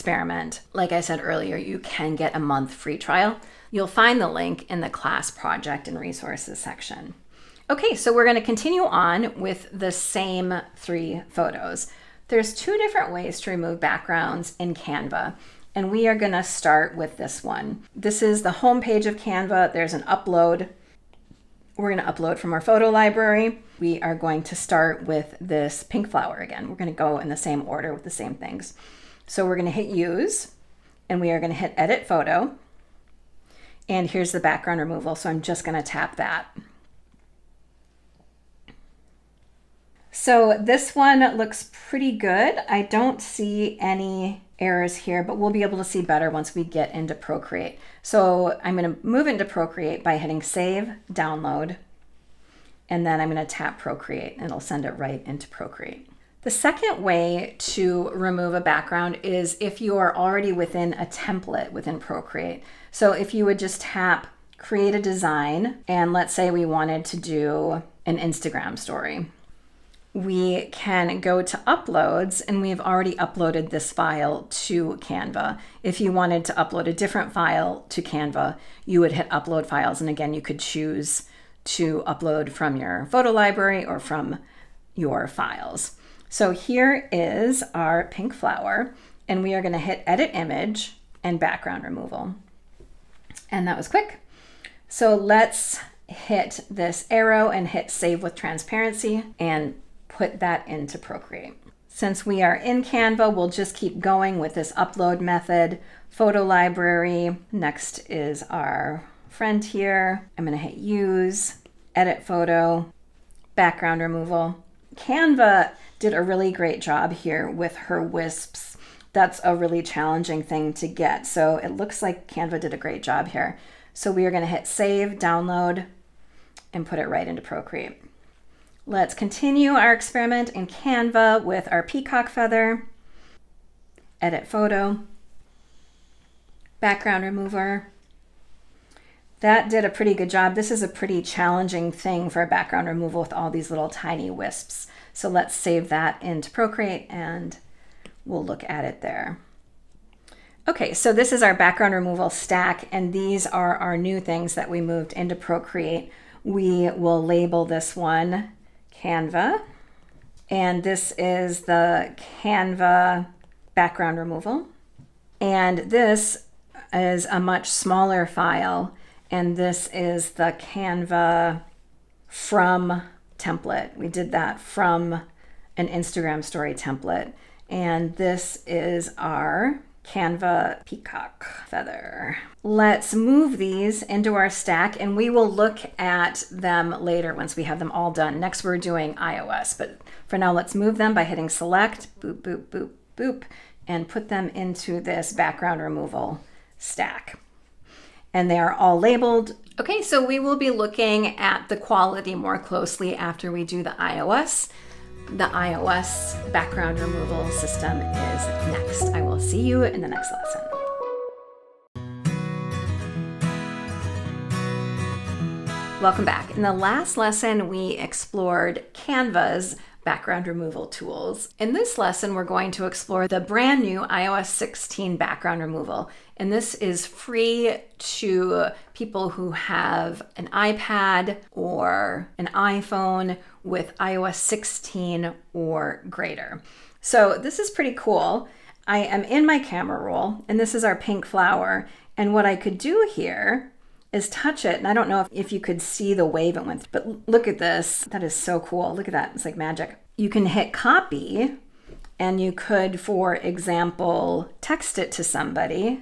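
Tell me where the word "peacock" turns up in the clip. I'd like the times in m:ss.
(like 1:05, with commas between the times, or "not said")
2:11, 3:00.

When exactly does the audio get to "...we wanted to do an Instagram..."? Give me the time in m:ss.
1:06.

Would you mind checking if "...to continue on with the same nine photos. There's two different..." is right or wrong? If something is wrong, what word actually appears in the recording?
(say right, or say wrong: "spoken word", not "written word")
wrong: "three", not "nine".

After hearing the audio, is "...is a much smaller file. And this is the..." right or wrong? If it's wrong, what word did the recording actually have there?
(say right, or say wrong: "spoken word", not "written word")
right.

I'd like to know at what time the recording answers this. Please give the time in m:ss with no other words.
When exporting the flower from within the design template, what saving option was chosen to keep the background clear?
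1:37.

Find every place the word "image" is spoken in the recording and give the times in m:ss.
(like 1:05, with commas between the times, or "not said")
1:30.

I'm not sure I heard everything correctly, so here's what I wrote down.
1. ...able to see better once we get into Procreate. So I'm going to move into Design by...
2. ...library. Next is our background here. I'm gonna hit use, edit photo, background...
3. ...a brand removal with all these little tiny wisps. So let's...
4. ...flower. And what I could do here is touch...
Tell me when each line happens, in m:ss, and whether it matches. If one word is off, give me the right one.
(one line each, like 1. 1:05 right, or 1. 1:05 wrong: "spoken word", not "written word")
1. 0:45 wrong: "Procreate", not "Design"
2. 1:46 wrong: "friend", not "background"
3. 2:22 wrong: "background", not "brand"
4. 4:01 right.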